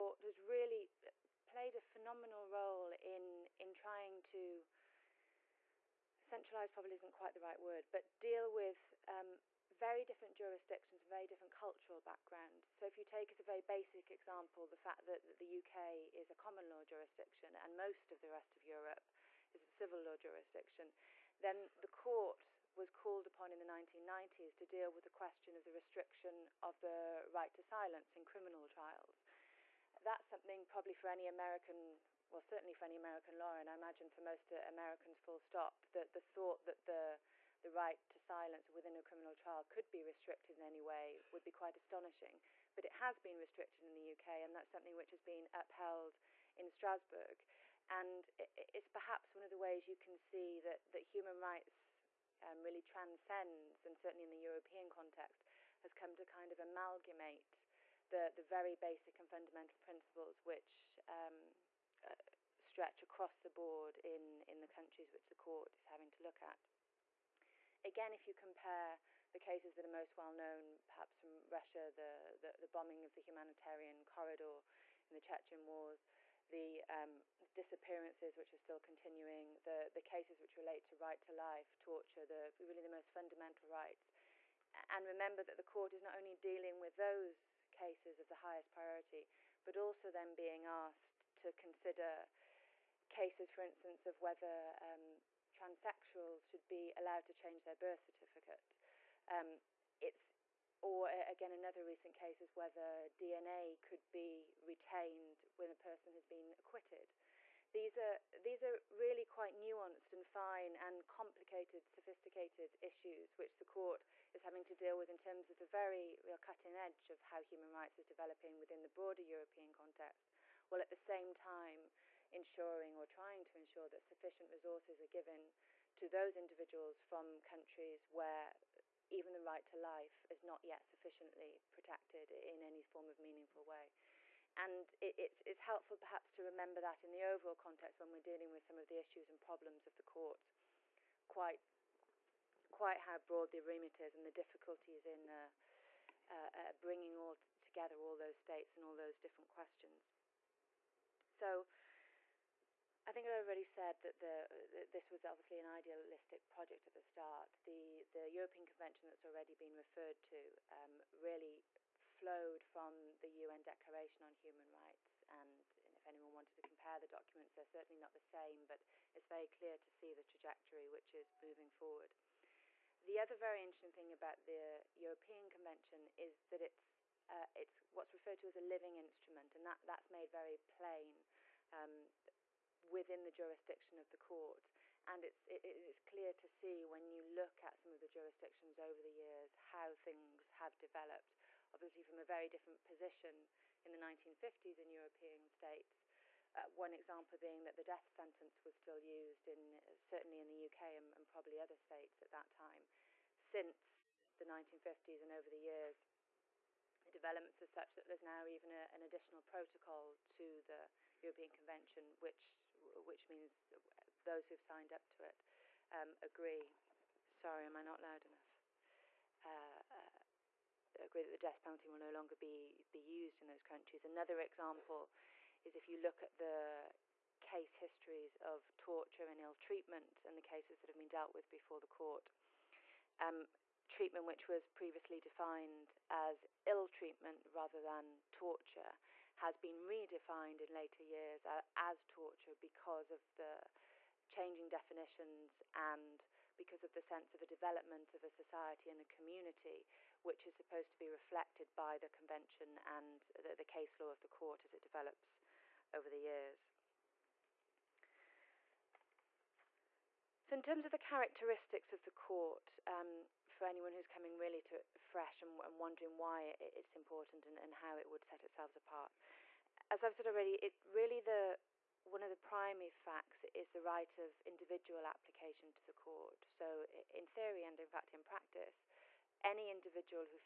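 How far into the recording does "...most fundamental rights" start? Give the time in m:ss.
1:22.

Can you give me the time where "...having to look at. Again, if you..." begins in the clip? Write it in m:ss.
1:05.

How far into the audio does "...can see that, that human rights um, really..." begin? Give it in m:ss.
0:50.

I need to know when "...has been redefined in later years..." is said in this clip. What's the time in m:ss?
3:59.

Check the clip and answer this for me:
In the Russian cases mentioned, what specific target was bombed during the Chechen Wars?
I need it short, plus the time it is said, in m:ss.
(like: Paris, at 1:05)
Humanitarian corridor, at 1:13.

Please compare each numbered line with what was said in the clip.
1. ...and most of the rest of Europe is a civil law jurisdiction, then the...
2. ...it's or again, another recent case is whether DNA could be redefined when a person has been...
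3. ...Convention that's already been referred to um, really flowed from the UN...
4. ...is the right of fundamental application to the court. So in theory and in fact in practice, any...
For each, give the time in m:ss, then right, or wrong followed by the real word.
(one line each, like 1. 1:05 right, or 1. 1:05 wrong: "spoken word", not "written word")
1. 0:17 right
2. 1:39 wrong: "retained", not "redefined"
3. 2:38 right
4. 4:33 wrong: "individual", not "fundamental".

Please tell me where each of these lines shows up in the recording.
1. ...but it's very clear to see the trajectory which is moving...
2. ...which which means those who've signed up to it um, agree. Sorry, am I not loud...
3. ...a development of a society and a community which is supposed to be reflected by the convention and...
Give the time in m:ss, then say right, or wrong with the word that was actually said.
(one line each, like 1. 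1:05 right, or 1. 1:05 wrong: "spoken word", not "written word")
1. 2:48 right
2. 3:32 right
3. 4:07 right.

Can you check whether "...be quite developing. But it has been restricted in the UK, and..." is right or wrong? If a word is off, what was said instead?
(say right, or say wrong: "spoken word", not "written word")
wrong: "astonishing", not "developing".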